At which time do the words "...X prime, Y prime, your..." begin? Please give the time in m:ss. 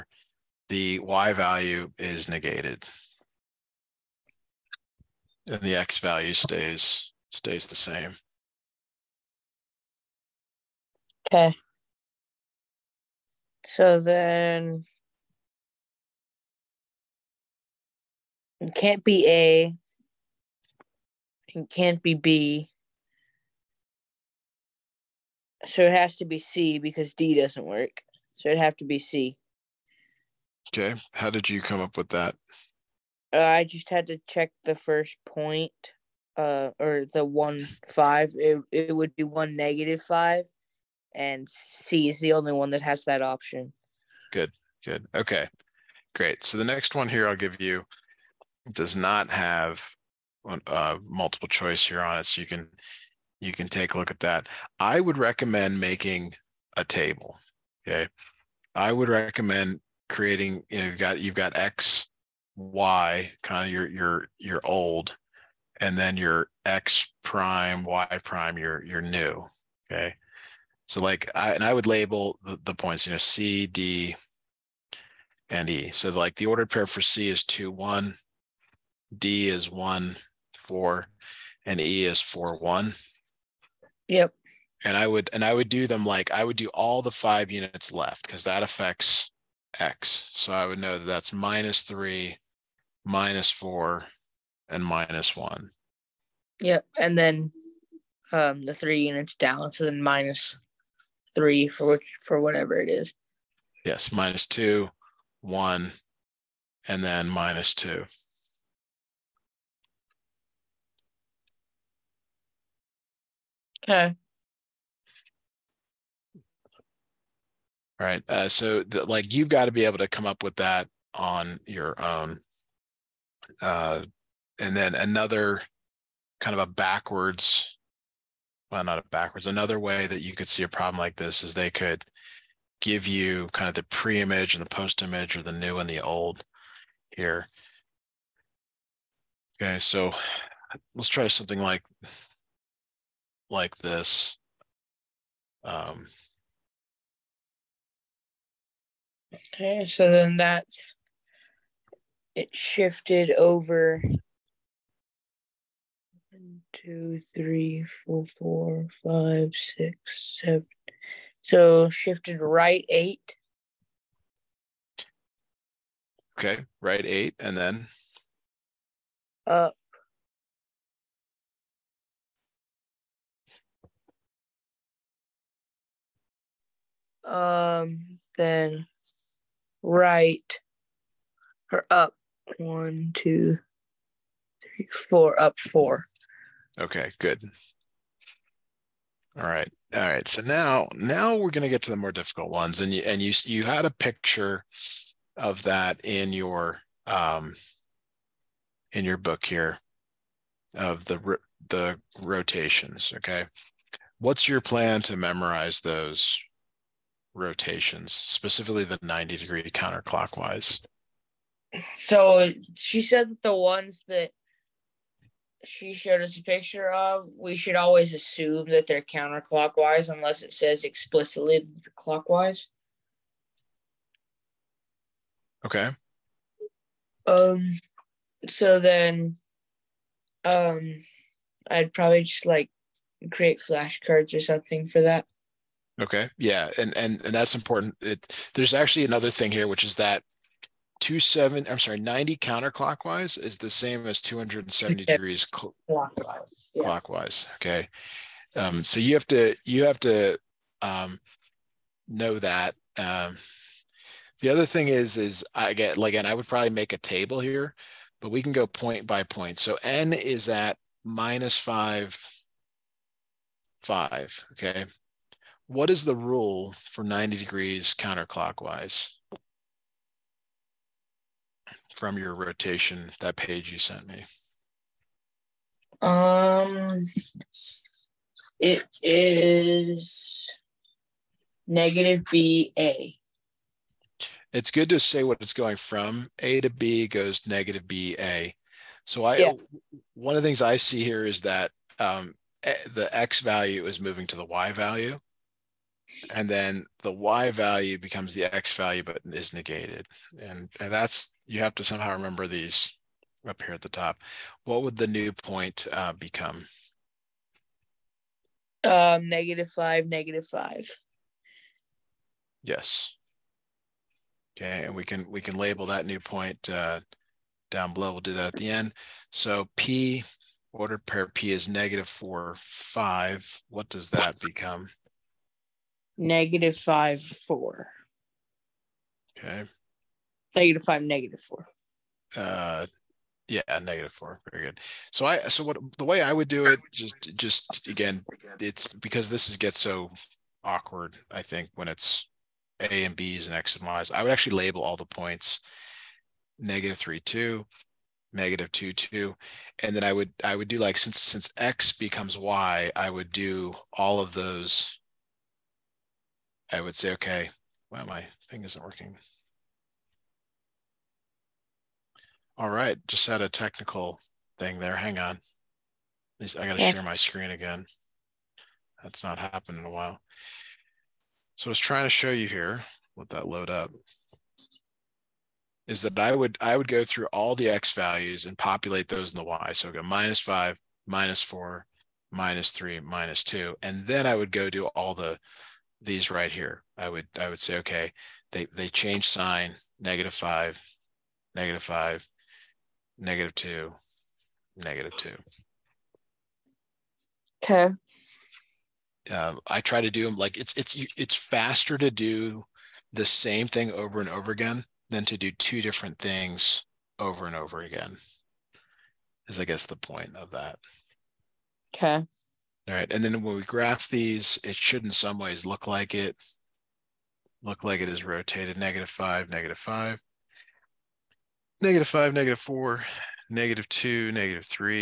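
1:06.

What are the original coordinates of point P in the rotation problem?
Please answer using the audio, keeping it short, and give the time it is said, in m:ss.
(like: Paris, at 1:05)
(-4, 5), at 5:21.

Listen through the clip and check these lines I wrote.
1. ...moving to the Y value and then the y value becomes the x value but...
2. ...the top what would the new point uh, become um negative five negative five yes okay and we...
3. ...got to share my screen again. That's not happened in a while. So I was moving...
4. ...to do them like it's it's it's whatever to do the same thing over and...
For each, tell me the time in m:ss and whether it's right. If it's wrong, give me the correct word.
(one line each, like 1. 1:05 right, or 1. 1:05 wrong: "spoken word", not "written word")
1. 4:53 right
2. 5:03 right
3. 6:06 wrong: "trying", not "moving"
4. 6:40 wrong: "faster", not "whatever".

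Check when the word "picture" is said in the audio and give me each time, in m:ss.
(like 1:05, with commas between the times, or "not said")
3:13, 3:36.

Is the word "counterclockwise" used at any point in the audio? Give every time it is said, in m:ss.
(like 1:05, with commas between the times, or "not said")
3:29, 3:39, 4:02, 4:27.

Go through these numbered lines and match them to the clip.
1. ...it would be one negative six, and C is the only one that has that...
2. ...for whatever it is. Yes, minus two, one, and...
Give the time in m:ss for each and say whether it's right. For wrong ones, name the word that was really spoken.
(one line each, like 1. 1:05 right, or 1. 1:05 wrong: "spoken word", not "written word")
1. 0:38 wrong: "five", not "six"
2. 1:42 right.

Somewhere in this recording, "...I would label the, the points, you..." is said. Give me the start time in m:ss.
1:11.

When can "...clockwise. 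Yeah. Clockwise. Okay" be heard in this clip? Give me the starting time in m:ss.
4:05.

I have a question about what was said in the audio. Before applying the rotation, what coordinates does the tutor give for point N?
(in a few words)
(-5, 5).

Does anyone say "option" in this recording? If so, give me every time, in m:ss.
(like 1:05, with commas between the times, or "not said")
0:43.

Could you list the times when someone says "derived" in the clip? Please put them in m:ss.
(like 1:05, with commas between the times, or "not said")
not said.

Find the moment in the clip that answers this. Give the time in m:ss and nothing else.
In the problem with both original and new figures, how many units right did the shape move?
2:41.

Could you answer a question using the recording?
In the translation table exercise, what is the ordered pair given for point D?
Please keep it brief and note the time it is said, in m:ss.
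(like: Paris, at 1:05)
(1, 4), at 1:19.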